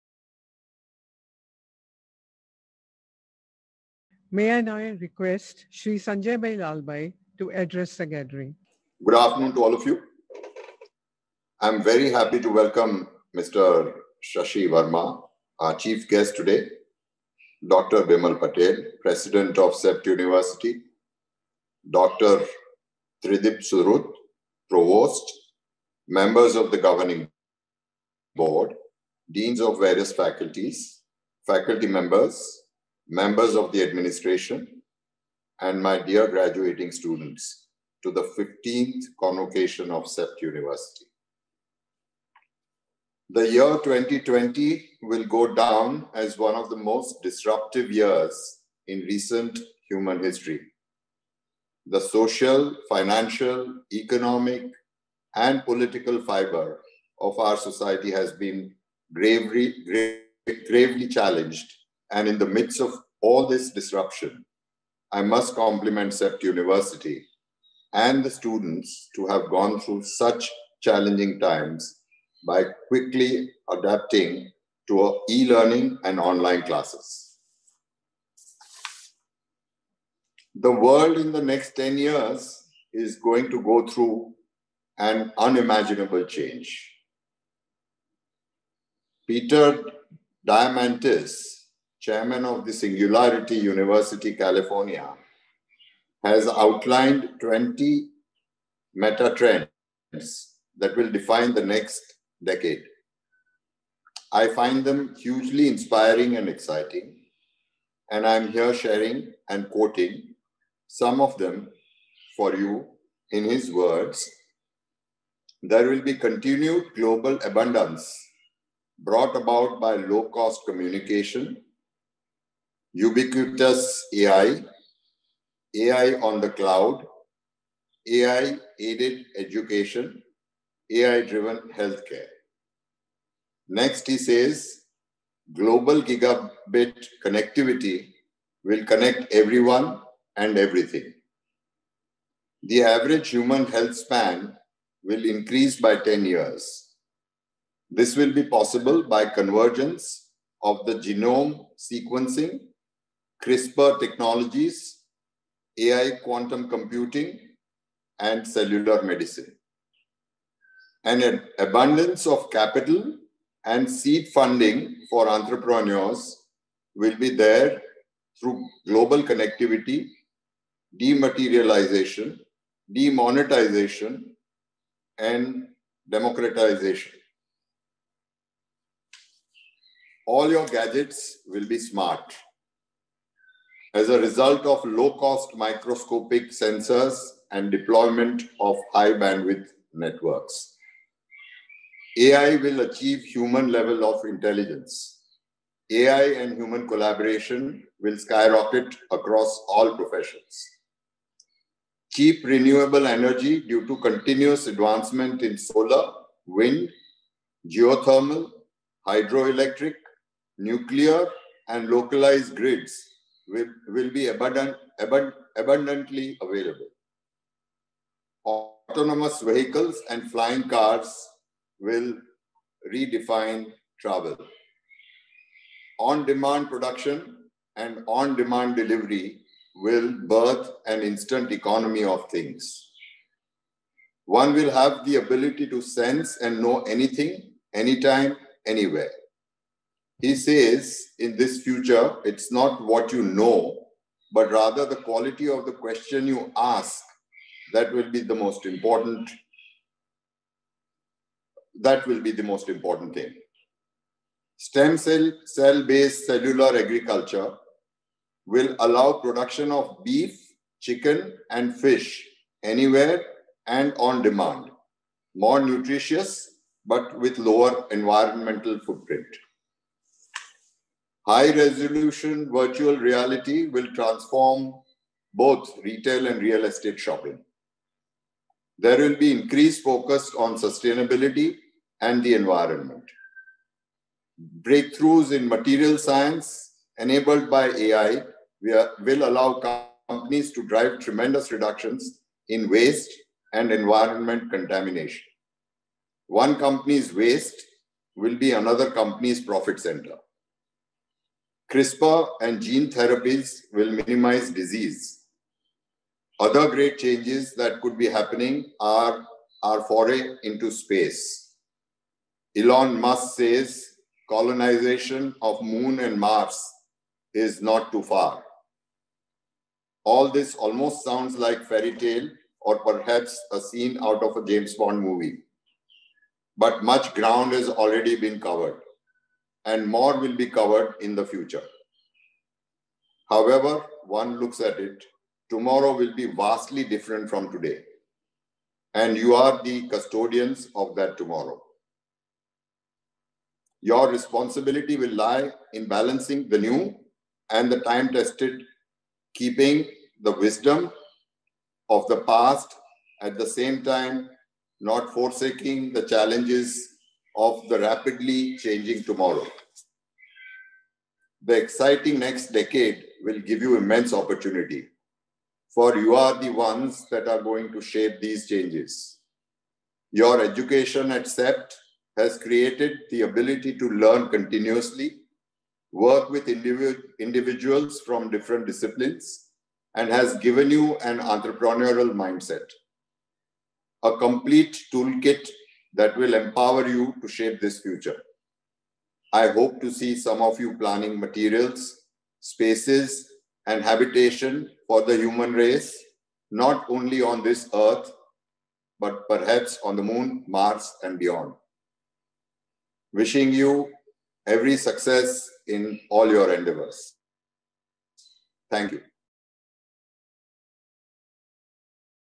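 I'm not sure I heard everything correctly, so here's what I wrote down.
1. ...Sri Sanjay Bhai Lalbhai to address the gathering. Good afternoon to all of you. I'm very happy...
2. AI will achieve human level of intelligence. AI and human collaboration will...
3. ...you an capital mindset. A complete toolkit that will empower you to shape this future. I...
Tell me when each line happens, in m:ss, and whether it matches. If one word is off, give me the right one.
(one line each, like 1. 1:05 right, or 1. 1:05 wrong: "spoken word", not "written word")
1. 0:05 right
2. 3:12 right
3. 6:20 wrong: "entrepreneurial", not "capital".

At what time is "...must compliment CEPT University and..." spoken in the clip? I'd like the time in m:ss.
1:05.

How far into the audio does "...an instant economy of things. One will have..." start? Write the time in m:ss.
3:50.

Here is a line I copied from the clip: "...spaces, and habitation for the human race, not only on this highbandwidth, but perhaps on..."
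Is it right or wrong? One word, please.
wrong.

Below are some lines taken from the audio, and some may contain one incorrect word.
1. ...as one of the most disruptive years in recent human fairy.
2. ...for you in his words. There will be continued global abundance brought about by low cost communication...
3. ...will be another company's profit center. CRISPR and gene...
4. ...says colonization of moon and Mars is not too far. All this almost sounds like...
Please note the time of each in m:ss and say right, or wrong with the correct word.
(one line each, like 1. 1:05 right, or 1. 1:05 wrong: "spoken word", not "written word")
1. 0:46 wrong: "history", not "fairy"
2. 1:52 right
3. 4:58 right
4. 5:13 right.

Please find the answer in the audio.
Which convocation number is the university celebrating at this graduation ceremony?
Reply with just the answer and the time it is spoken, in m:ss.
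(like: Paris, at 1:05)
15th, at 0:38.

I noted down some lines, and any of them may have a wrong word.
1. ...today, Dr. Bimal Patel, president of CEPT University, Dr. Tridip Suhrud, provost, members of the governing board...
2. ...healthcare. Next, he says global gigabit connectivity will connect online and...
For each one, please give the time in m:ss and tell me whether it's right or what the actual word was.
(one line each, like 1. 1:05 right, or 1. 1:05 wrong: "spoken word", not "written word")
1. 0:16 right
2. 2:11 wrong: "everyone", not "online".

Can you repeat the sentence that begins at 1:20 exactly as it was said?
The world in the next 10 years is going to go through an unimaginable change.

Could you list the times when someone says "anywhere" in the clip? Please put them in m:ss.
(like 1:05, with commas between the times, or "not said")
3:58, 4:22.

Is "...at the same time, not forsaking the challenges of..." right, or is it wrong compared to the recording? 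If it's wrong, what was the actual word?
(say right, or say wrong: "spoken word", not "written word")
right.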